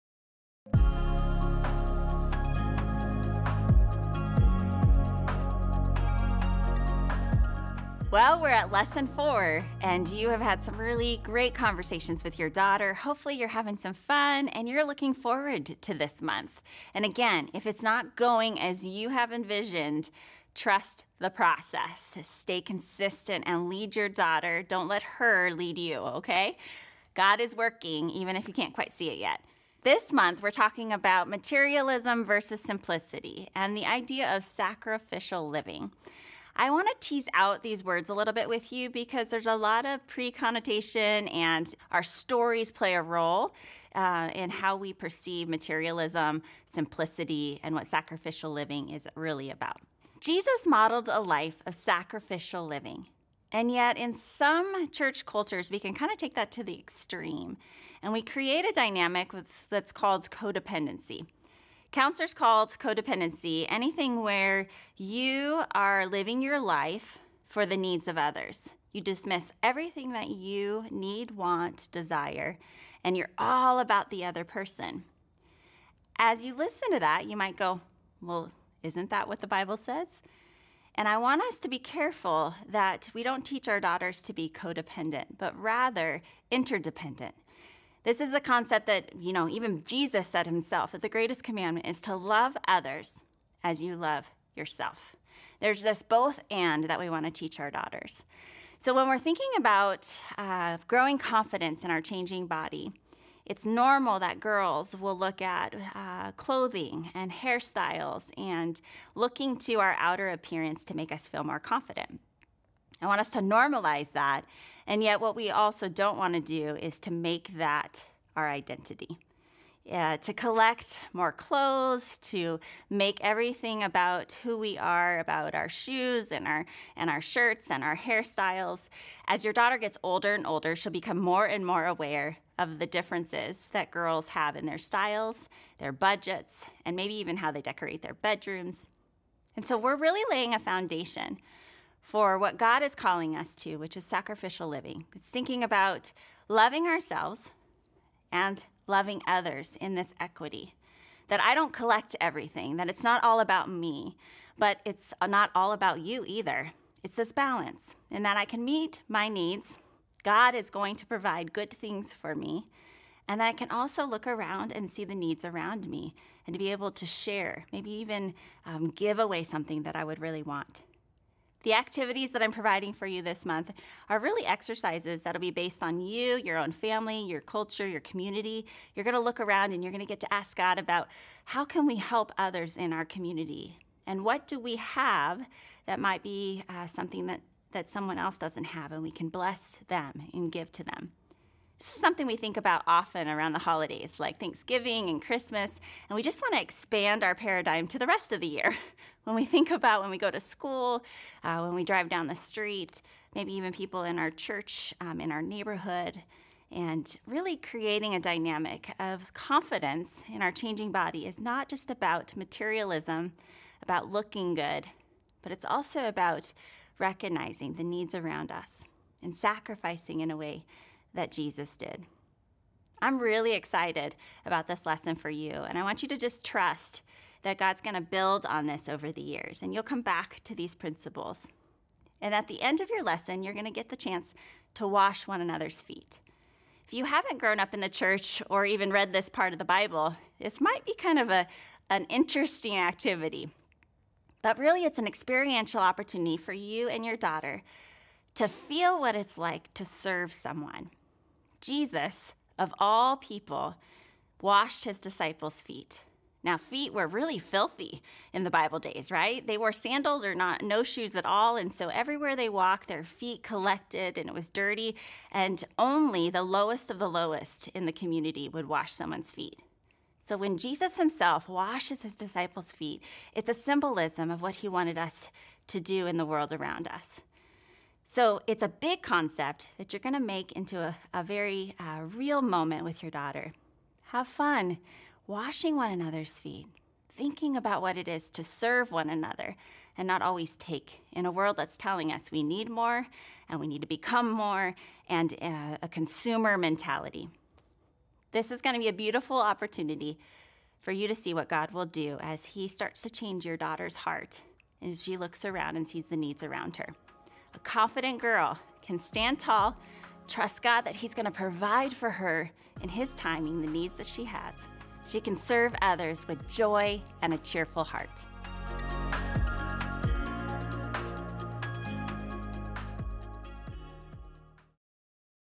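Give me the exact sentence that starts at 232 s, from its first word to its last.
And at the end of your lesson, you're going to get the chance to wash one another's feet.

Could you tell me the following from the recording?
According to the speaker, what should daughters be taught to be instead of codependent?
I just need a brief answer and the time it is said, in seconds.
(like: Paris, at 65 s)
Interdependent, at 86 s.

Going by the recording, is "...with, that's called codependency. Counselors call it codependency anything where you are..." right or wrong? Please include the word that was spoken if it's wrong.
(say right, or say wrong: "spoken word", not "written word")
right.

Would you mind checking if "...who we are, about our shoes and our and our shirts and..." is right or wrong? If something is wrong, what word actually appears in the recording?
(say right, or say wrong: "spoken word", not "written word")
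right.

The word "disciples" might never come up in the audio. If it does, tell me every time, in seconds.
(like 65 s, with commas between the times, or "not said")
254 s, 272 s.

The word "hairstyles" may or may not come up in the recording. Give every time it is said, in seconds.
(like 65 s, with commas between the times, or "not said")
107 s, 127 s.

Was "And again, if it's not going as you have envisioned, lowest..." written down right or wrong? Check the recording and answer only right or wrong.
wrong.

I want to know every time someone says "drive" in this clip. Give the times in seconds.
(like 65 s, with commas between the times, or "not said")
201 s.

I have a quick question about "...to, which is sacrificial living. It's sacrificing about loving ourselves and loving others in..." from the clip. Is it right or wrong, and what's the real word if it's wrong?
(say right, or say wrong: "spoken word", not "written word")
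wrong: "thinking", not "sacrificing".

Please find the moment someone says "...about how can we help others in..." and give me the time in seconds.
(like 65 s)
180 s.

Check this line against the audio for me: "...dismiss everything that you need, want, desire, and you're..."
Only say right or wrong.
right.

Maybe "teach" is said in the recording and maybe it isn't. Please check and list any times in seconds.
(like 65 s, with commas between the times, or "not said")
83 s, 97 s.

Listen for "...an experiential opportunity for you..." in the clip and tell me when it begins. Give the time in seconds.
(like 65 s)
244 s.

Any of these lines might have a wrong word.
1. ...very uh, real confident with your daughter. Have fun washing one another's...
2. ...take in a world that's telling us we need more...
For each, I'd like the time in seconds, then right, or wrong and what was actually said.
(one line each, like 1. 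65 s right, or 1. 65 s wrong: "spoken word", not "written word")
1. 281 s wrong: "moment", not "confident"
2. 290 s right.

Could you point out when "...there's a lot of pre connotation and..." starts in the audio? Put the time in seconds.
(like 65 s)
39 s.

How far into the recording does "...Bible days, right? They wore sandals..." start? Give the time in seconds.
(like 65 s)
258 s.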